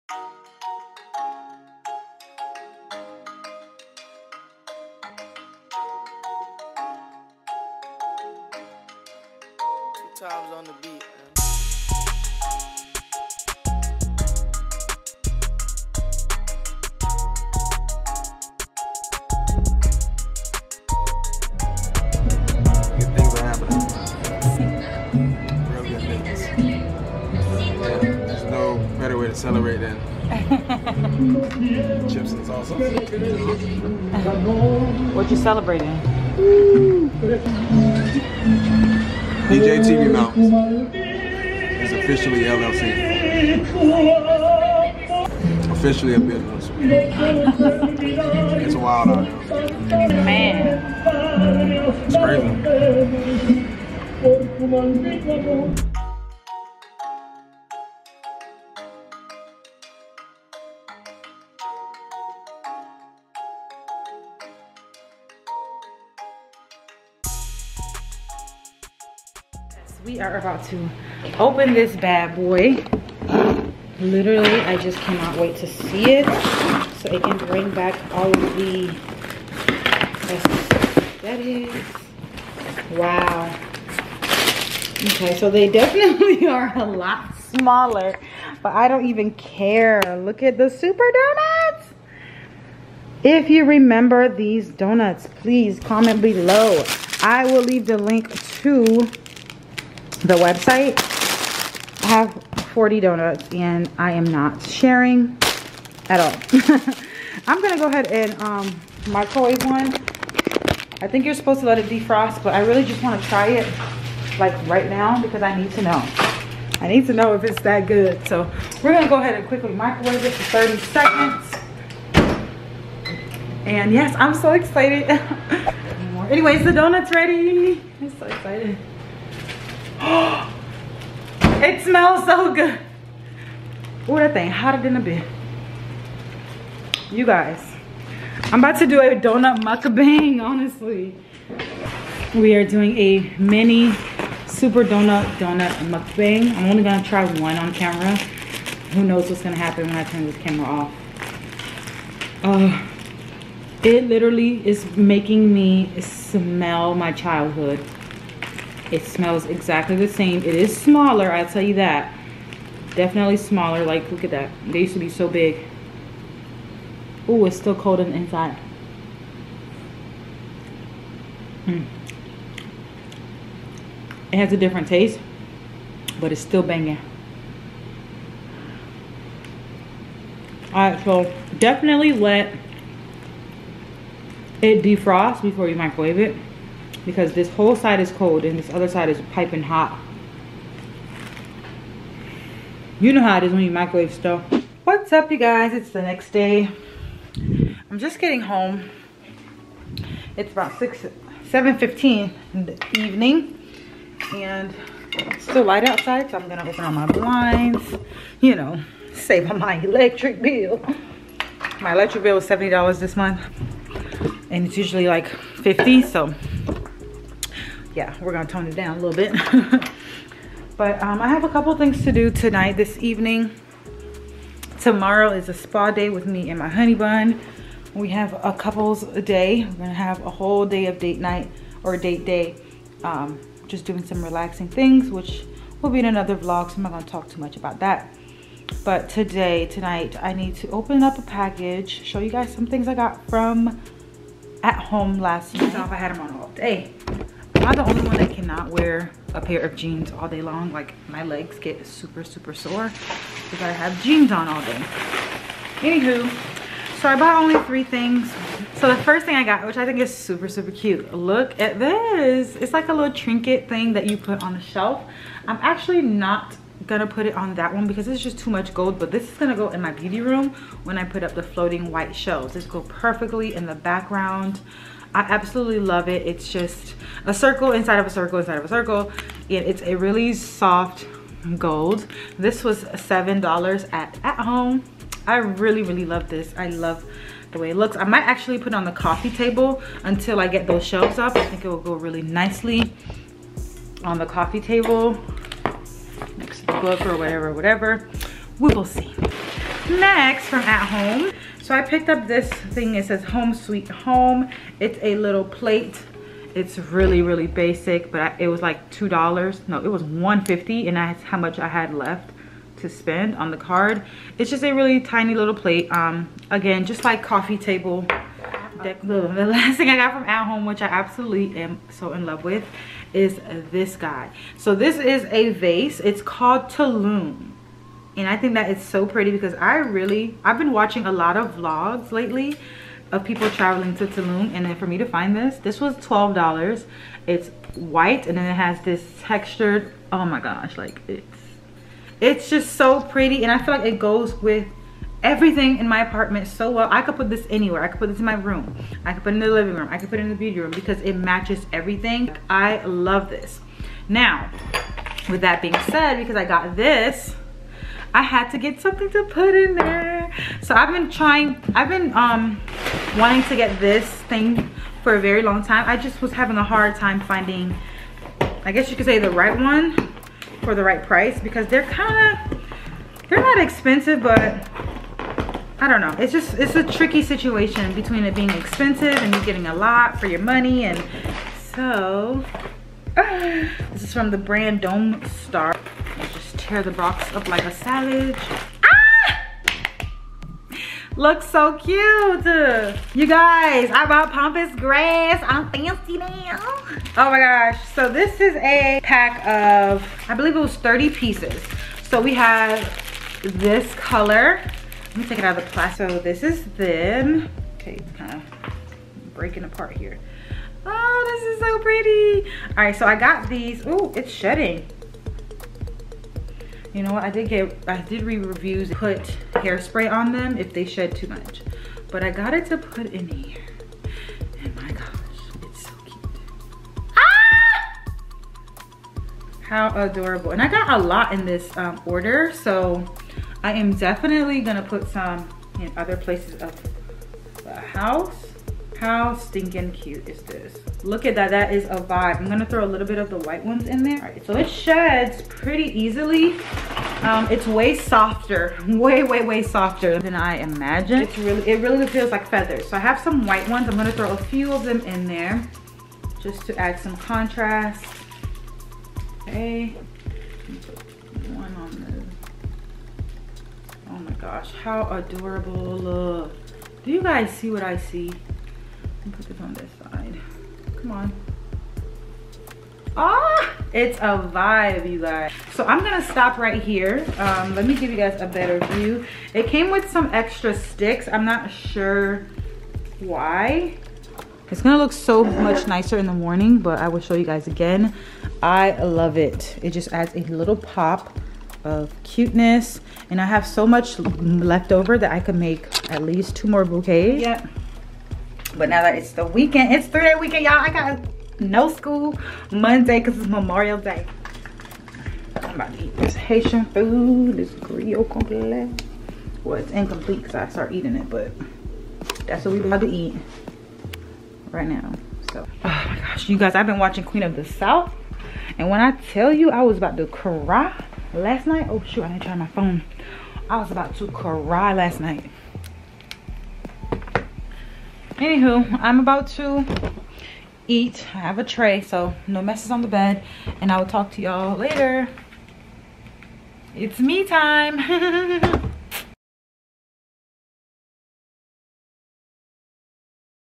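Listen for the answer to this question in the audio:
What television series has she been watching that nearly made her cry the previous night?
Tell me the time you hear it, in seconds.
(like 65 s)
517 s.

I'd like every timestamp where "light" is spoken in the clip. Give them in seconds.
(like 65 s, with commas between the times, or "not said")
205 s.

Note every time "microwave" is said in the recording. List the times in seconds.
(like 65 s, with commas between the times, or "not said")
109 s, 119 s, 185 s, 193 s.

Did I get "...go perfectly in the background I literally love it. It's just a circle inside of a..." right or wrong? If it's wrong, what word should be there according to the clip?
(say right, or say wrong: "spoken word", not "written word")
wrong: "absolutely", not "literally".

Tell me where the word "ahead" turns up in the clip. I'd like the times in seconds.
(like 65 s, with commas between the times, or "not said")
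107 s, 119 s.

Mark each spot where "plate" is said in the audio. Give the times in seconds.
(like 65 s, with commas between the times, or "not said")
305 s, 315 s.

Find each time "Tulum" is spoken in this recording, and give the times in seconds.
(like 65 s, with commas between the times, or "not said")
326 s, 334 s.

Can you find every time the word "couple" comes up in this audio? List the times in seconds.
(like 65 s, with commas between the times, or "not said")
221 s, 228 s.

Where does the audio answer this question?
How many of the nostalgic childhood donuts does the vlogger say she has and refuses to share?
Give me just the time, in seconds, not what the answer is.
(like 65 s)
102 s.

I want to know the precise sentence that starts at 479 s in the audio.
It came with some extra sticks.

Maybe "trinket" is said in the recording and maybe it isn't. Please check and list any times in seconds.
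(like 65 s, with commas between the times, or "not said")
263 s.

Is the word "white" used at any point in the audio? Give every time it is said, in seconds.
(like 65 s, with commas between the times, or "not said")
271 s, 337 s, 443 s, 453 s.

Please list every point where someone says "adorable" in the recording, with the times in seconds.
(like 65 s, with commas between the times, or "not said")
430 s, 465 s.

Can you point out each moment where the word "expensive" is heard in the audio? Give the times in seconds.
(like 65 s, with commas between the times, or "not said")
373 s, 378 s.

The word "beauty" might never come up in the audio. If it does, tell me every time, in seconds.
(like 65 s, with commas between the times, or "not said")
269 s, 350 s.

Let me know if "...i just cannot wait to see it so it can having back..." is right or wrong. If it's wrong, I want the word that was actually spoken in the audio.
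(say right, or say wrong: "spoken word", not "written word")
wrong: "bring", not "having".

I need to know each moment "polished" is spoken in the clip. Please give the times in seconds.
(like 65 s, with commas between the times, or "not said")
not said.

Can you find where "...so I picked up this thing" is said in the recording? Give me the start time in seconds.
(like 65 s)
301 s.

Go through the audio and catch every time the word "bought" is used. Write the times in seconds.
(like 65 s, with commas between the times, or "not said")
257 s, 394 s.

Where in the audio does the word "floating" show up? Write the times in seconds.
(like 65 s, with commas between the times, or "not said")
271 s.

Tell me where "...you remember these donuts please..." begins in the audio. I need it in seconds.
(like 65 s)
93 s.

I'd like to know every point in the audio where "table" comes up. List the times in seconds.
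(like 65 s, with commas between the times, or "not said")
289 s, 294 s, 317 s.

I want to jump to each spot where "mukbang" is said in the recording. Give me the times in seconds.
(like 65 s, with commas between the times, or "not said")
139 s, 145 s.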